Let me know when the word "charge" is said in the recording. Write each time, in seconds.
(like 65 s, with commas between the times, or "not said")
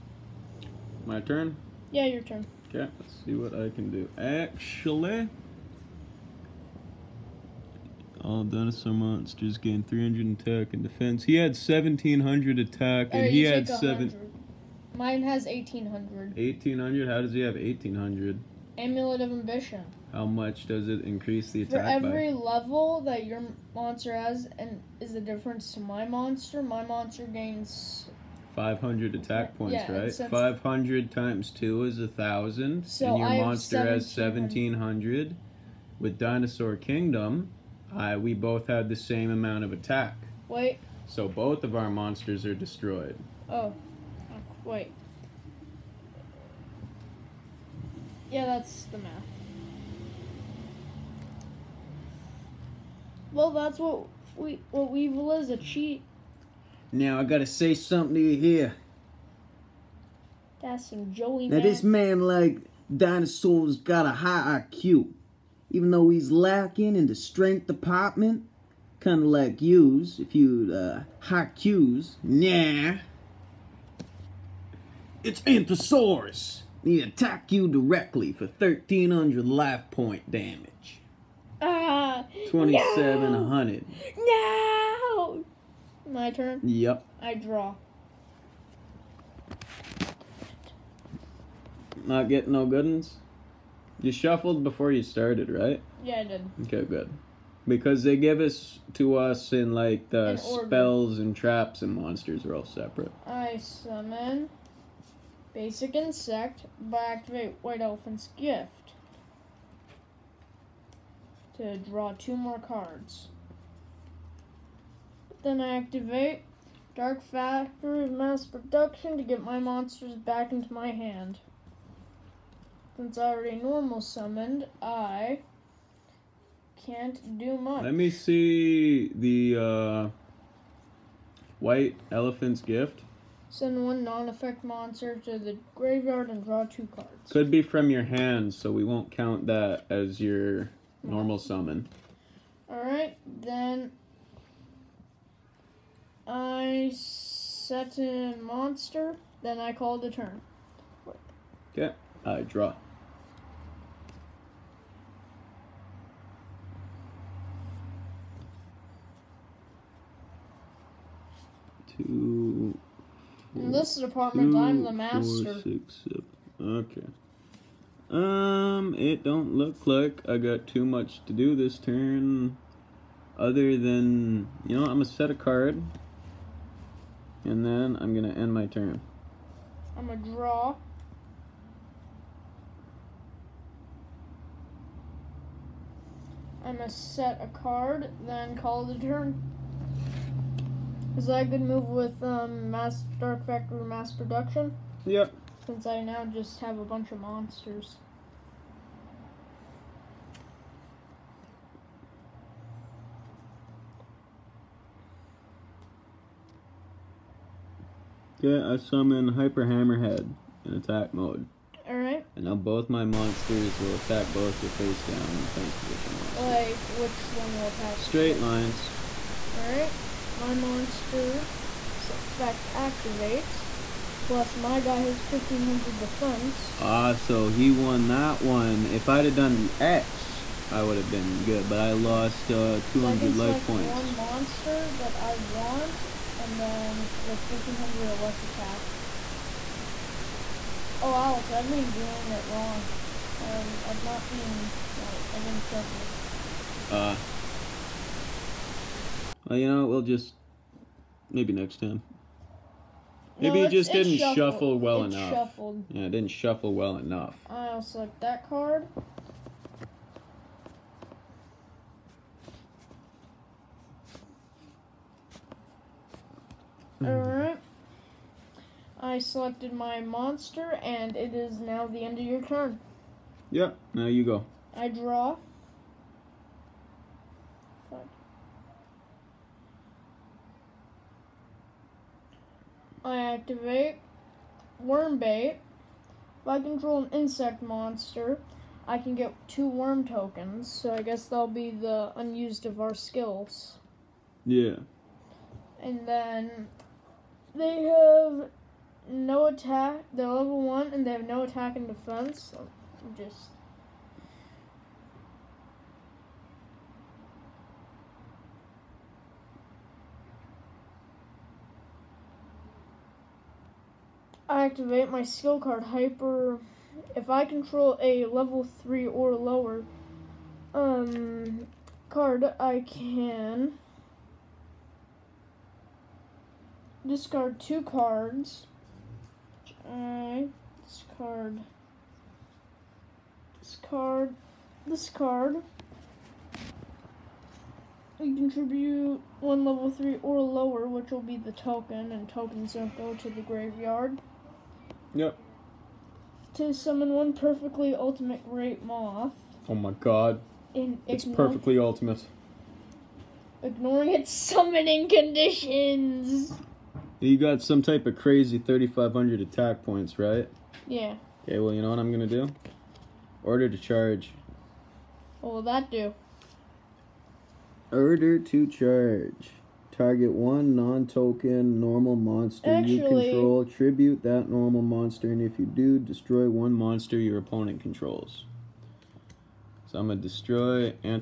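363 s, 368 s.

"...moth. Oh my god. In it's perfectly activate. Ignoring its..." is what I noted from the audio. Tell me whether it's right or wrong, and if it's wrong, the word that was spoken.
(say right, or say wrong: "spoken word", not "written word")
wrong: "ultimate", not "activate".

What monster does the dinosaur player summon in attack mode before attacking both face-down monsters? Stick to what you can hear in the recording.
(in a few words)
Hyper Hammerhead.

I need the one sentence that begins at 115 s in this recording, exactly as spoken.
Then I activate Dark Factory mass production to get my monsters back into my hand.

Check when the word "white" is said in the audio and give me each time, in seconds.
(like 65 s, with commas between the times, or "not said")
107 s, 131 s.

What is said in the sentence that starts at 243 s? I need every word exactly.
Um, I've not been, like, I didn't shuffle.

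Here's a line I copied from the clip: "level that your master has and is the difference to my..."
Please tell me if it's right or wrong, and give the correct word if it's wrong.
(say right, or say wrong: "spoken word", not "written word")
wrong: "monster", not "master".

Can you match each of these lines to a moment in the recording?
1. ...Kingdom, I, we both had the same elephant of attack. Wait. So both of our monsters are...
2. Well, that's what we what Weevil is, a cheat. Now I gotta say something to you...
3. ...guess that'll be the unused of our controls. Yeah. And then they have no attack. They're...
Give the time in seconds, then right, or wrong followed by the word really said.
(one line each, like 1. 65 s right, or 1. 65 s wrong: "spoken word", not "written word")
1. 36 s wrong: "amount", not "elephant"
2. 53 s right
3. 291 s wrong: "skills", not "controls".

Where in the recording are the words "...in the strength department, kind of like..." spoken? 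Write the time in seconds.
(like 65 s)
66 s.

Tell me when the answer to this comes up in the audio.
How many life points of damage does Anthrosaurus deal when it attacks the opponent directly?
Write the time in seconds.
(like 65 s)
78 s.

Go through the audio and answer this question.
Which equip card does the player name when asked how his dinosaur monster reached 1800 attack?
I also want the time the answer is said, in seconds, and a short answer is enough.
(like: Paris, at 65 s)
Amulet of Ambition, at 18 s.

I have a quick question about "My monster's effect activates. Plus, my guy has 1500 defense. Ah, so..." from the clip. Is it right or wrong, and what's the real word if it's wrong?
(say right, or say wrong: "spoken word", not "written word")
right.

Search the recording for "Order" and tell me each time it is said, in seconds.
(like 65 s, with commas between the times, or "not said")
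363 s, 367 s.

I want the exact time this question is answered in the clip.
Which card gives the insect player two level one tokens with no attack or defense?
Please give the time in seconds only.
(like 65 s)
284 s.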